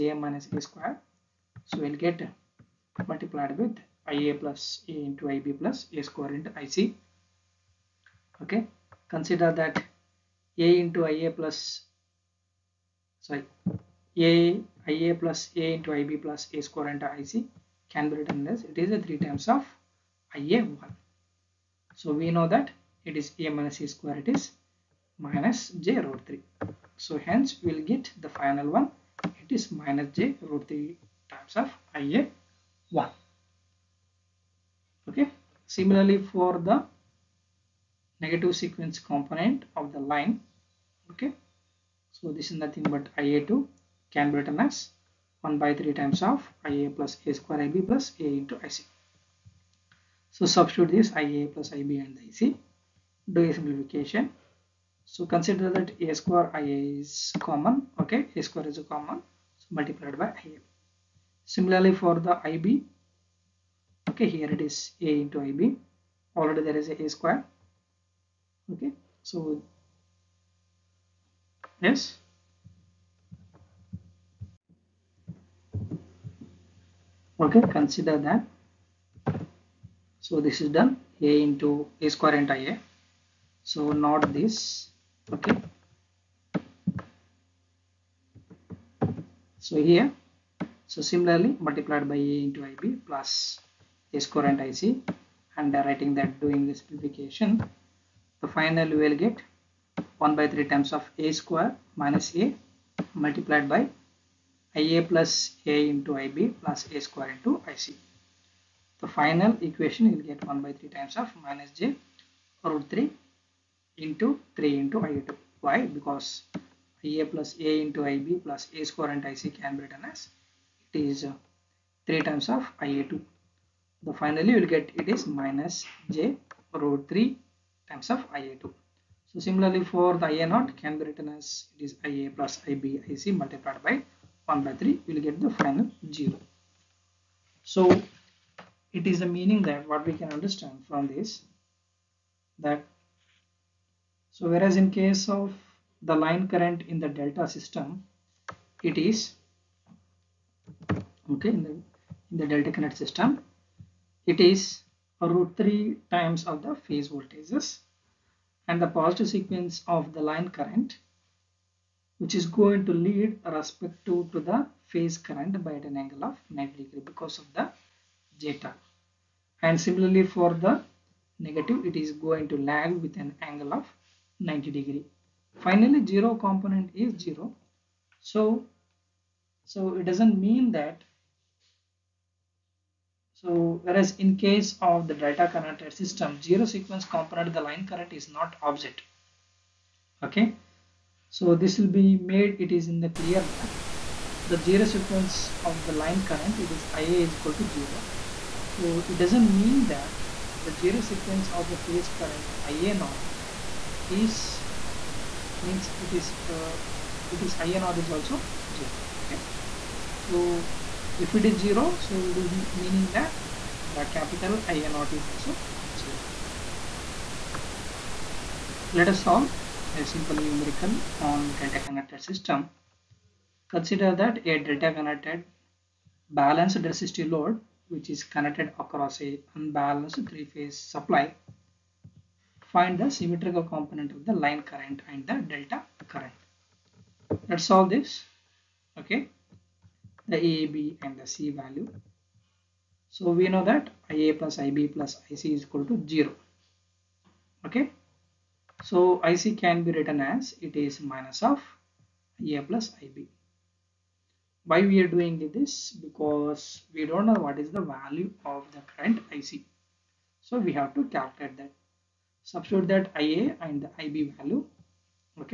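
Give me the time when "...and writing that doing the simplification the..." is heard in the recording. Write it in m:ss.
1:35.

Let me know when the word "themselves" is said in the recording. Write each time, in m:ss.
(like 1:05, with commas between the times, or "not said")
not said.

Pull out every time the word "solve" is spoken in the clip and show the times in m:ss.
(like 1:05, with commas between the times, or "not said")
3:39, 3:57.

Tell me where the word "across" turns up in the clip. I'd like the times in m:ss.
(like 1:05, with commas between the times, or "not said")
3:48.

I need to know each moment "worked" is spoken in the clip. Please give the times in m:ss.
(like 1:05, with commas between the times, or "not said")
not said.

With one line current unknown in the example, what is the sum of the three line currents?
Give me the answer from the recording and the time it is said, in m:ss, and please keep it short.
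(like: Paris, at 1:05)
0, at 4:05.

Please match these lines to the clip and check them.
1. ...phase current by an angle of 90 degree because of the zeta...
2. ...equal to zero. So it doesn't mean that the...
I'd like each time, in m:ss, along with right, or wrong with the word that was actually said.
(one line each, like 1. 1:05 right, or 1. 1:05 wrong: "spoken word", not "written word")
1. 2:44 right
2. 3:17 right.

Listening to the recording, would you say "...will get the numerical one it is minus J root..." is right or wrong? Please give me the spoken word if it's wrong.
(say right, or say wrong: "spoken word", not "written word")
wrong: "final", not "numerical".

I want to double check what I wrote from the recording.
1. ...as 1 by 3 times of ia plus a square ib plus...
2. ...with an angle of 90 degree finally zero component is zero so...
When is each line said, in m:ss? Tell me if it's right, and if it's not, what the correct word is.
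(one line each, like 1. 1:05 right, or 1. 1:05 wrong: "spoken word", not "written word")
1. 0:44 right
2. 2:53 right.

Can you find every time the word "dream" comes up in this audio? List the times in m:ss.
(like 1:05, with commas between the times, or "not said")
not said.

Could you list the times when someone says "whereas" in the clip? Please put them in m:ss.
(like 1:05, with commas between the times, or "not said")
2:24, 3:03.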